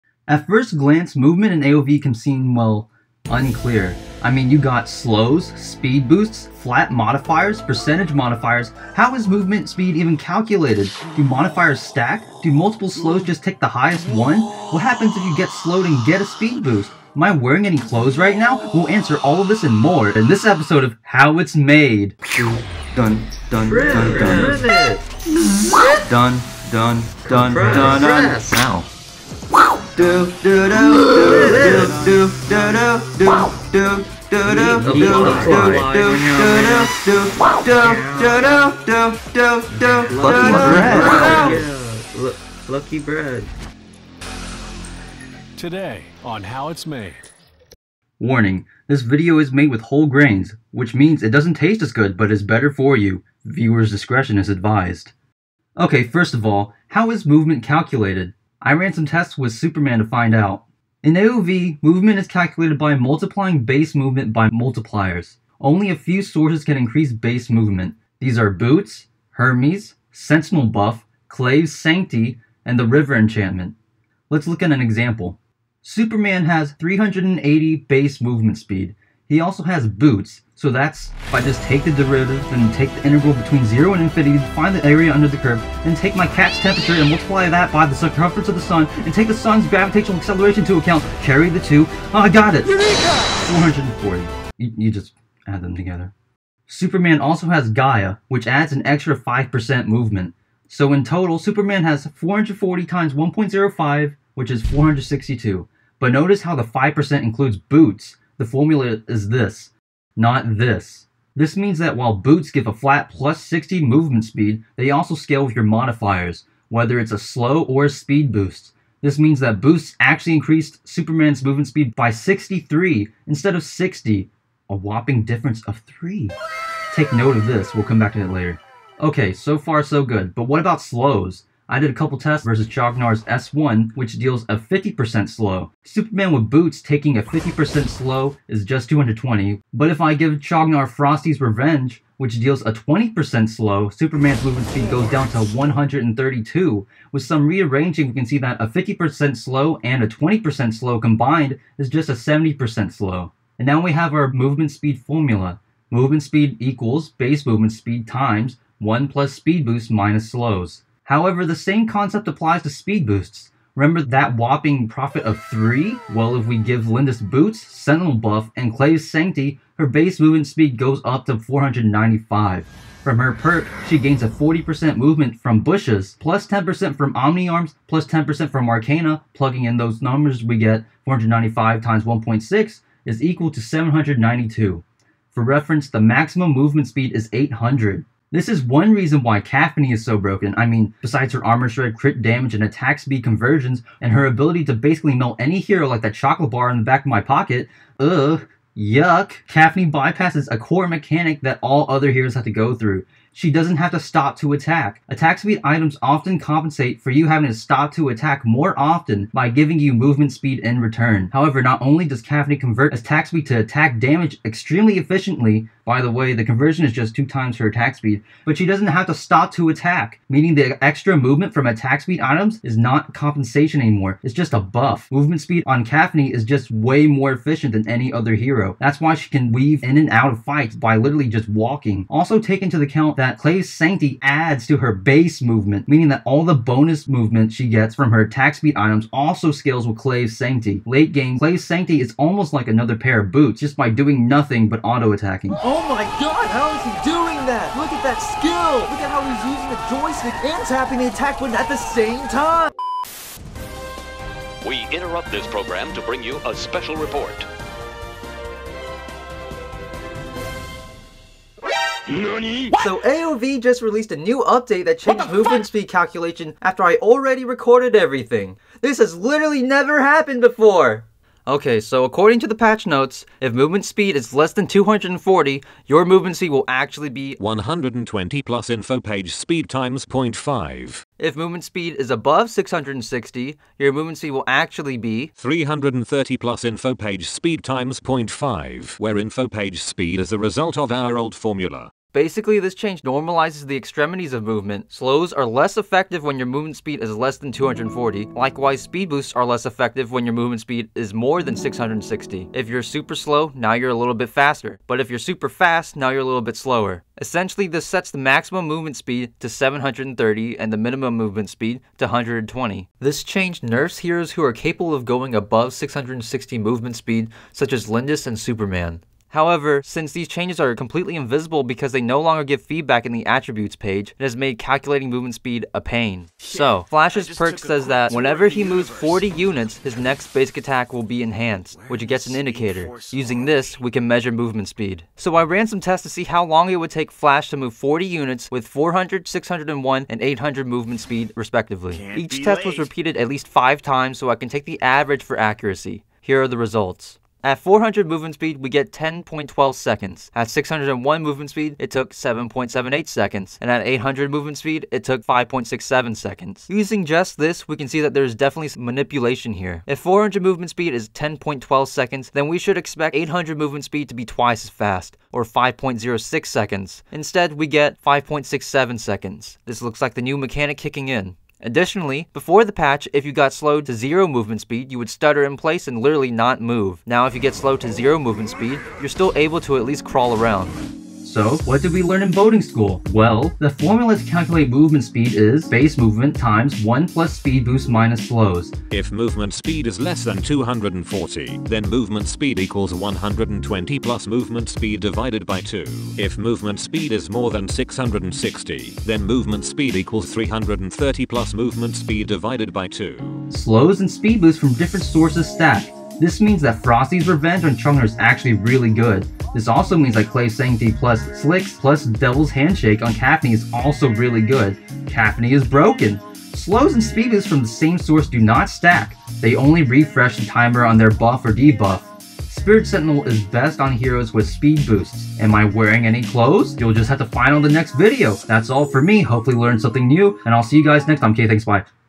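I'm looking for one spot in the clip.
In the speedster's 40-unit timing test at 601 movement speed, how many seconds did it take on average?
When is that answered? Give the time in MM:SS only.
05:52.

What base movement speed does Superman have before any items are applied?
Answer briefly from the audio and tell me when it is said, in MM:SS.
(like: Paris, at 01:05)
380, at 01:16.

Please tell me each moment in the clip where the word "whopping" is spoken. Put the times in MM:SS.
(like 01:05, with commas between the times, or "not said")
02:04, 02:44.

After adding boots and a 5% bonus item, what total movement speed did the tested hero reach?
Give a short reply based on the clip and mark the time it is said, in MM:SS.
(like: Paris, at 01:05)
462, at 01:44.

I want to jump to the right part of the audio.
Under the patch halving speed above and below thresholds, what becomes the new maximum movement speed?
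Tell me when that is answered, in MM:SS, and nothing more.
05:09.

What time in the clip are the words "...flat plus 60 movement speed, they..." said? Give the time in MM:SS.
01:52.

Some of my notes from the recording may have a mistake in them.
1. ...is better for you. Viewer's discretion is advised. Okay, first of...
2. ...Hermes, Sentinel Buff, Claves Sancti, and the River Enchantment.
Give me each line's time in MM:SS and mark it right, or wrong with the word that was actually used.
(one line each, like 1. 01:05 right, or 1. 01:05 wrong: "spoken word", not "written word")
1. 00:52 right
2. 01:09 right.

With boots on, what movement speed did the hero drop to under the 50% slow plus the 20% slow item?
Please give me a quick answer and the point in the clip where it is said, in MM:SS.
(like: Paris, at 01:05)
132, at 02:25.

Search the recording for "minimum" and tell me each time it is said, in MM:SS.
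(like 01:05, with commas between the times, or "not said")
05:10.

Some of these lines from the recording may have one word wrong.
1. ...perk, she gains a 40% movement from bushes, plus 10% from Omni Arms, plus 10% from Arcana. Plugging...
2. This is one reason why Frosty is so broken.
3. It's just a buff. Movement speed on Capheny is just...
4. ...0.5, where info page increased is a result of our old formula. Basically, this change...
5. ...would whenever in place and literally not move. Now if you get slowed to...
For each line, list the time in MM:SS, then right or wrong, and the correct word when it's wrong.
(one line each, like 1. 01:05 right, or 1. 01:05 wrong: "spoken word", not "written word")
1. 02:53 right
2. 03:08 wrong: "Capheny", not "Frosty"
3. 03:44 right
4. 04:47 wrong: "speed", not "increased"
5. 06:14 wrong: "stutter", not "whenever".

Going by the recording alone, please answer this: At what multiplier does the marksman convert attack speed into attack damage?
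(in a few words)
2 times attack speed.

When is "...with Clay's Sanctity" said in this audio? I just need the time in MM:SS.
03:59.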